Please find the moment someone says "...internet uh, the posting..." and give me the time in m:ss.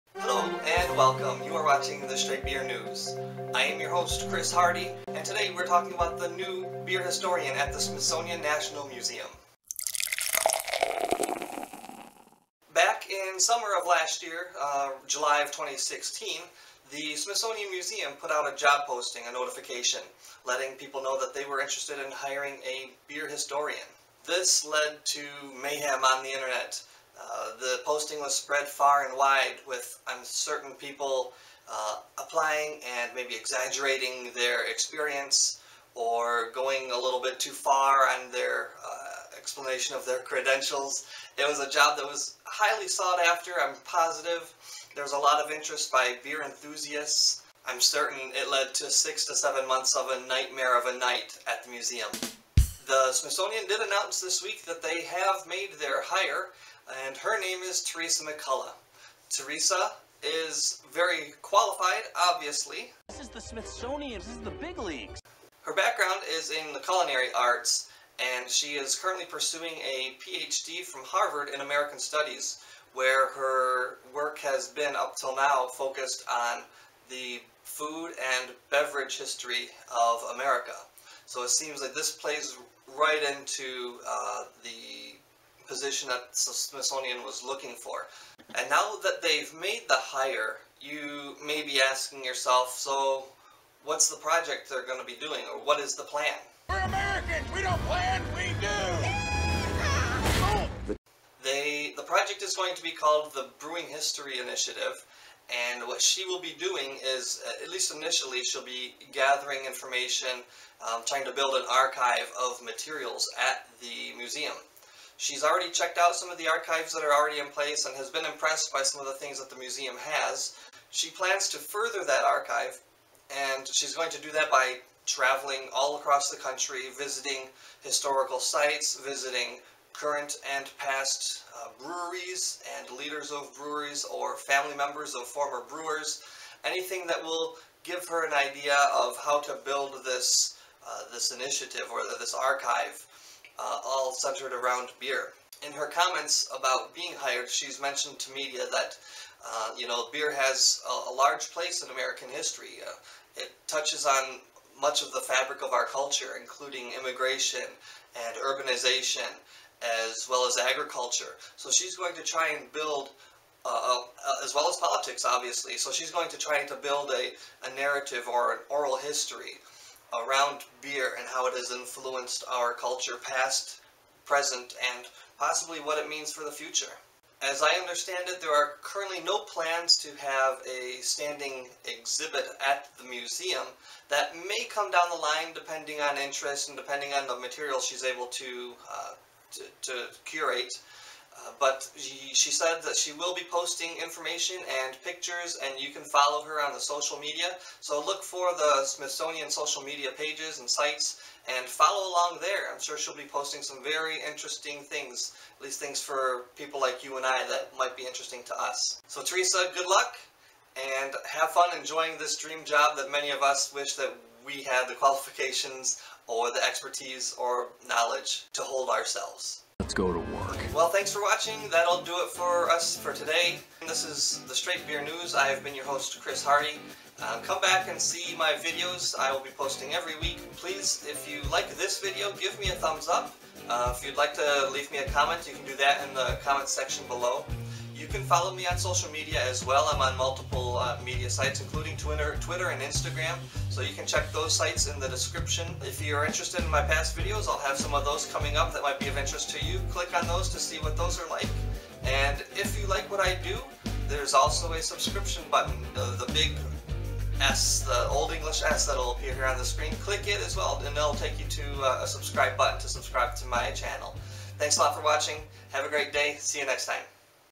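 0:26.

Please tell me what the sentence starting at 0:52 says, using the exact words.
The Smithsonian did announce this week that they have made their hire and her name is Theresa McCulla.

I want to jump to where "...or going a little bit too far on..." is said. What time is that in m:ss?
0:35.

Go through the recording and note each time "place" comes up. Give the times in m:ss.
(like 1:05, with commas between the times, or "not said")
1:57, 2:31.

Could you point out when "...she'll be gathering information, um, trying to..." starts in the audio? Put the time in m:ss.
1:48.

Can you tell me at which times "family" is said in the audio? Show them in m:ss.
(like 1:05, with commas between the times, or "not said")
2:14.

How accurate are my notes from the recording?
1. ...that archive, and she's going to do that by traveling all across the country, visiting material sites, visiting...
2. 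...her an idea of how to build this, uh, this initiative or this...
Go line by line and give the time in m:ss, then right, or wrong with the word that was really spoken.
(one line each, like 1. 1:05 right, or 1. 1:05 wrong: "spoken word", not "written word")
1. 2:02 wrong: "historical", not "material"
2. 2:18 right.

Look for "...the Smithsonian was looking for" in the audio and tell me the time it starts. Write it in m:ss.
1:26.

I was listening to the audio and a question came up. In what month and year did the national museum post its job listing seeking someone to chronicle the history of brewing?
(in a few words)
July 2016.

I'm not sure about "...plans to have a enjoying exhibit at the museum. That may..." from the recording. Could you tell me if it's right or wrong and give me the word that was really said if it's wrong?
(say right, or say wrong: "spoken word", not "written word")
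wrong: "standing", not "enjoying".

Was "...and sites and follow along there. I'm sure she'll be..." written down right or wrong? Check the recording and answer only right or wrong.
right.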